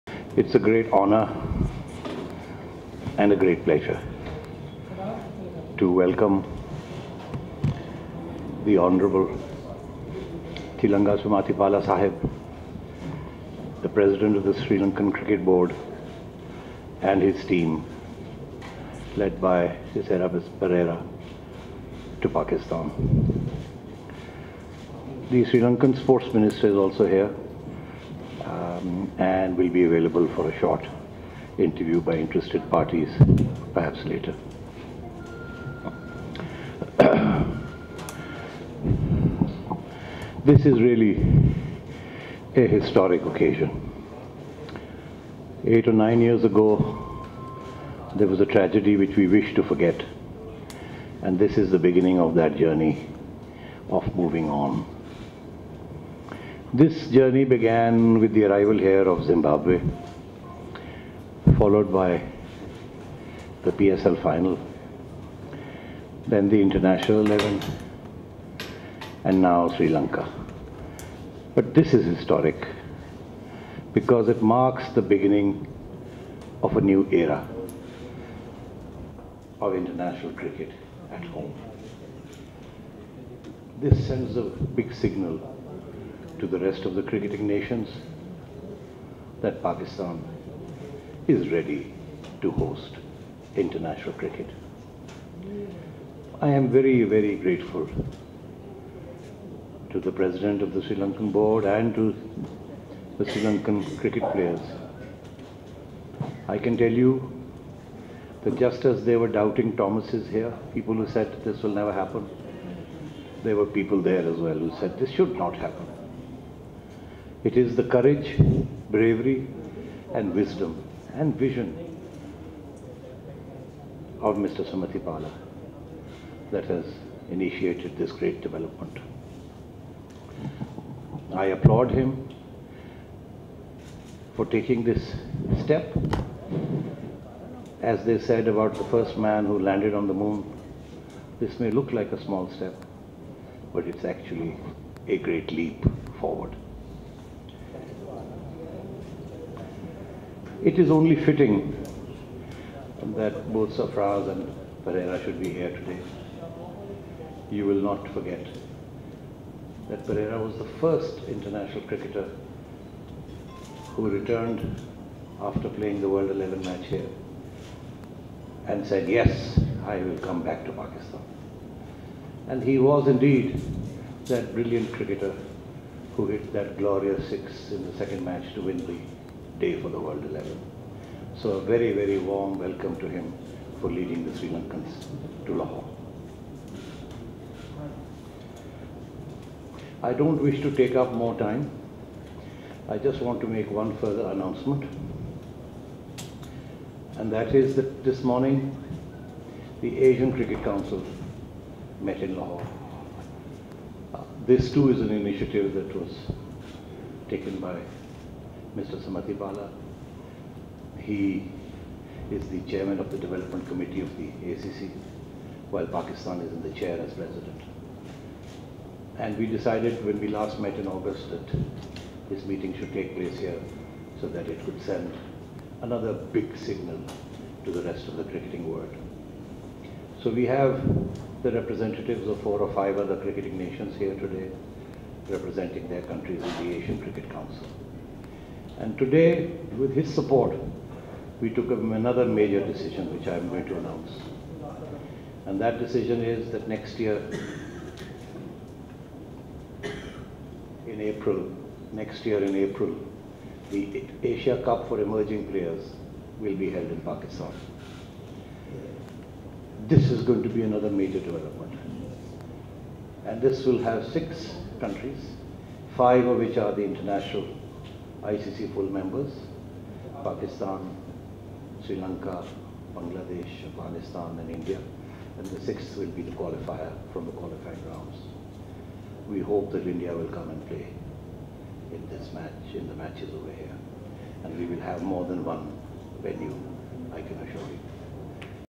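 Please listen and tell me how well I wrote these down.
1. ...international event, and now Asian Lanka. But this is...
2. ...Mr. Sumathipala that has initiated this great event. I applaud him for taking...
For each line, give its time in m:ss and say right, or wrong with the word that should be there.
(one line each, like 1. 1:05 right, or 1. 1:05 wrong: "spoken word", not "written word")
1. 1:06 wrong: "Sri", not "Asian"
2. 2:04 wrong: "development", not "event".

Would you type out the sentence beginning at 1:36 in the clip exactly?
I am very, very grateful to the President of the Sri Lankan Board and to the Sri Lankan cricket players.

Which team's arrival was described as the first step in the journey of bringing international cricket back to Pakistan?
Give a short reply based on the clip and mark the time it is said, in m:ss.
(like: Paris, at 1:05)
Zimbabwe, at 0:59.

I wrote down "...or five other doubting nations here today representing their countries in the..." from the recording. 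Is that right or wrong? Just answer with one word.
wrong.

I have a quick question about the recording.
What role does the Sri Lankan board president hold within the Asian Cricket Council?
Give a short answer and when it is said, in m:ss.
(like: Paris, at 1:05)
Chairman of the development committee, at 3:32.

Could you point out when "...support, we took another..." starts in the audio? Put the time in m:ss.
4:00.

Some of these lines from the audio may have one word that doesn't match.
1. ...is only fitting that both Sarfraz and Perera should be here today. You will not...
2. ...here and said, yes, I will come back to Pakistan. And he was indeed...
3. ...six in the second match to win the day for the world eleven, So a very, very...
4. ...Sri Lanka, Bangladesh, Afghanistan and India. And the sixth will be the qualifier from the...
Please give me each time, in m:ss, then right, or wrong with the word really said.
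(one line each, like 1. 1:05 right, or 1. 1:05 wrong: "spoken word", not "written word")
1. 2:30 right
2. 2:46 right
3. 2:57 right
4. 4:31 right.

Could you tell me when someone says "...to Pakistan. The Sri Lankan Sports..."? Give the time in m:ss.
0:22.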